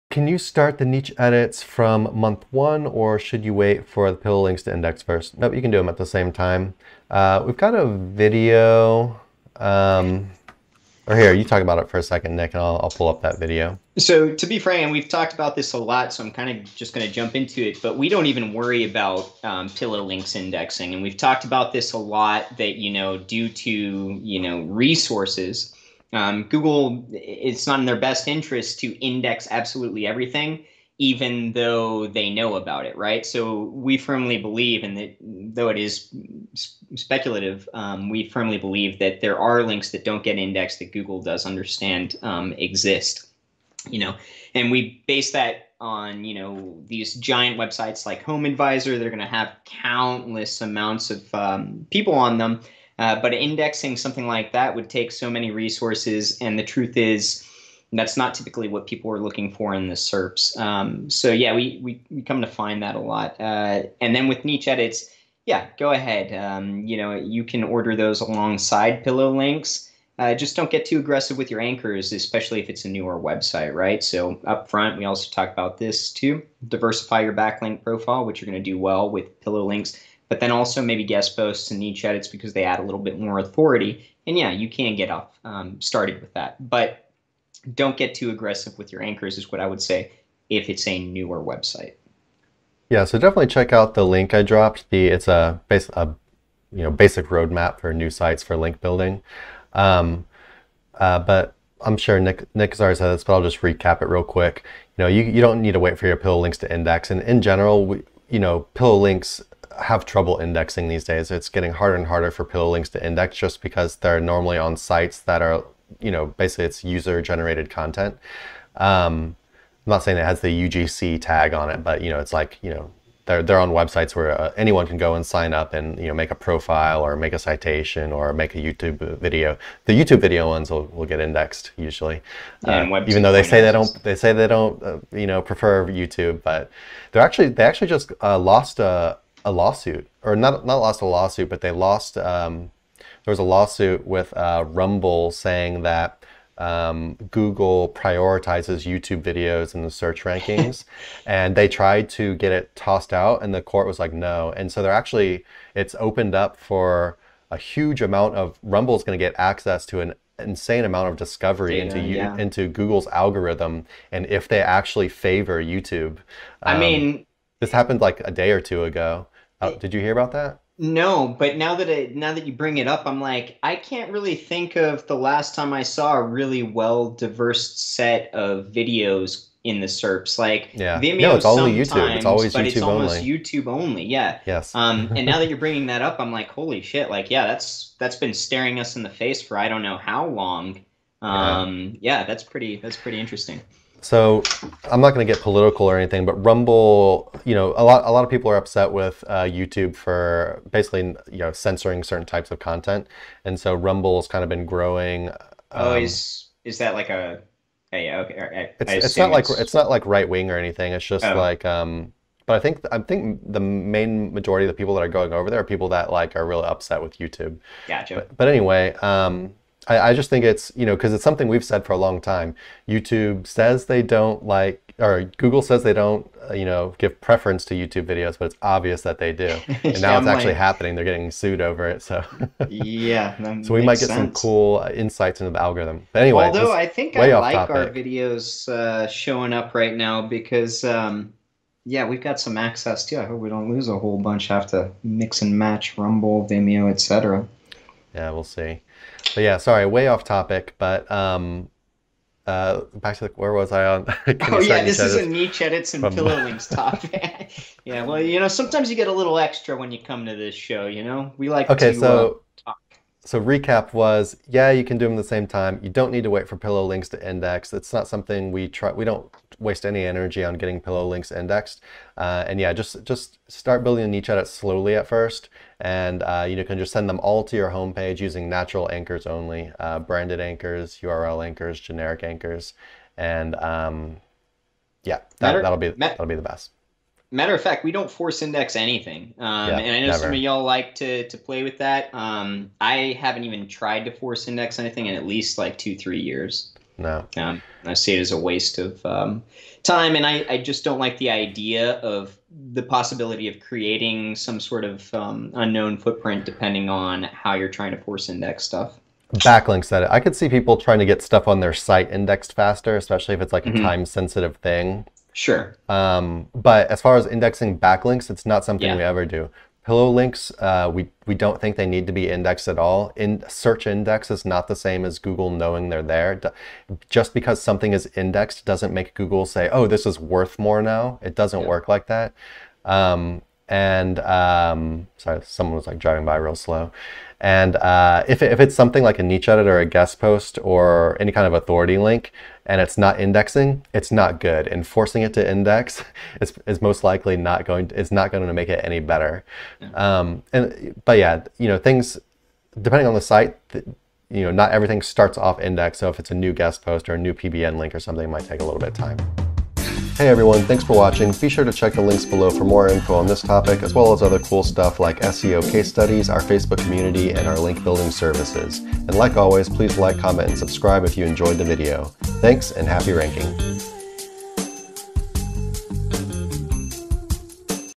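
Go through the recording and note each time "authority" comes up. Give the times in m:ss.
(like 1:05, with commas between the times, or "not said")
1:23, 5:41.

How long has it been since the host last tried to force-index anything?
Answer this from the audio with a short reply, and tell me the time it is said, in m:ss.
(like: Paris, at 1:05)
2-3 years, at 4:55.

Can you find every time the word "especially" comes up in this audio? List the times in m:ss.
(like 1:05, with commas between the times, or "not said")
1:12, 5:12.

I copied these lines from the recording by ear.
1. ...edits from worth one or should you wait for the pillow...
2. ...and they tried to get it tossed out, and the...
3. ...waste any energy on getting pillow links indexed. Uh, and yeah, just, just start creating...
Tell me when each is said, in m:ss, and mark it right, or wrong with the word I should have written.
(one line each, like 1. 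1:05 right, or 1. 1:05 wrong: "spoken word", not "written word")
1. 0:01 wrong: "month", not "worth"
2. 2:31 right
3. 4:29 wrong: "building", not "creating".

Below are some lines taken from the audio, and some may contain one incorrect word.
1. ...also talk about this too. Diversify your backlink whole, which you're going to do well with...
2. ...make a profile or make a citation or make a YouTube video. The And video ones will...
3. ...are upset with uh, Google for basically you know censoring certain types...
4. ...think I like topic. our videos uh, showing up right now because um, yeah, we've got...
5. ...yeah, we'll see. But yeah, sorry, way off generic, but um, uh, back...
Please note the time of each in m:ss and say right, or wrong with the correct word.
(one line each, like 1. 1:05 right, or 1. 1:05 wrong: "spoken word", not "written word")
1. 1:15 wrong: "profile", not "whole"
2. 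2:06 wrong: "YouTube", not "And"
3. 3:18 wrong: "YouTube", not "Google"
4. 3:56 right
5. 4:08 wrong: "topic", not "generic".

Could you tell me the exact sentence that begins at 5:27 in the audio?
Just because something is indexed doesn't make Google say, oh, this is worth more now.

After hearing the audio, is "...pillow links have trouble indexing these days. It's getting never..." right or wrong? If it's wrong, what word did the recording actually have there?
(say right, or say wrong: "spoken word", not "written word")
wrong: "harder", not "never".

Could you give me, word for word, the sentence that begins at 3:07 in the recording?
Like, yeah, that's that's been staring us in the face for I don't know how long.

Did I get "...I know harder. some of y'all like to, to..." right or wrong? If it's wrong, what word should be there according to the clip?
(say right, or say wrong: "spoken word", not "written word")
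wrong: "never", not "harder".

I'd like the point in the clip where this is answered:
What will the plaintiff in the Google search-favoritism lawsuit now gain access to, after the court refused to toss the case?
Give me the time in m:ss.
2:41.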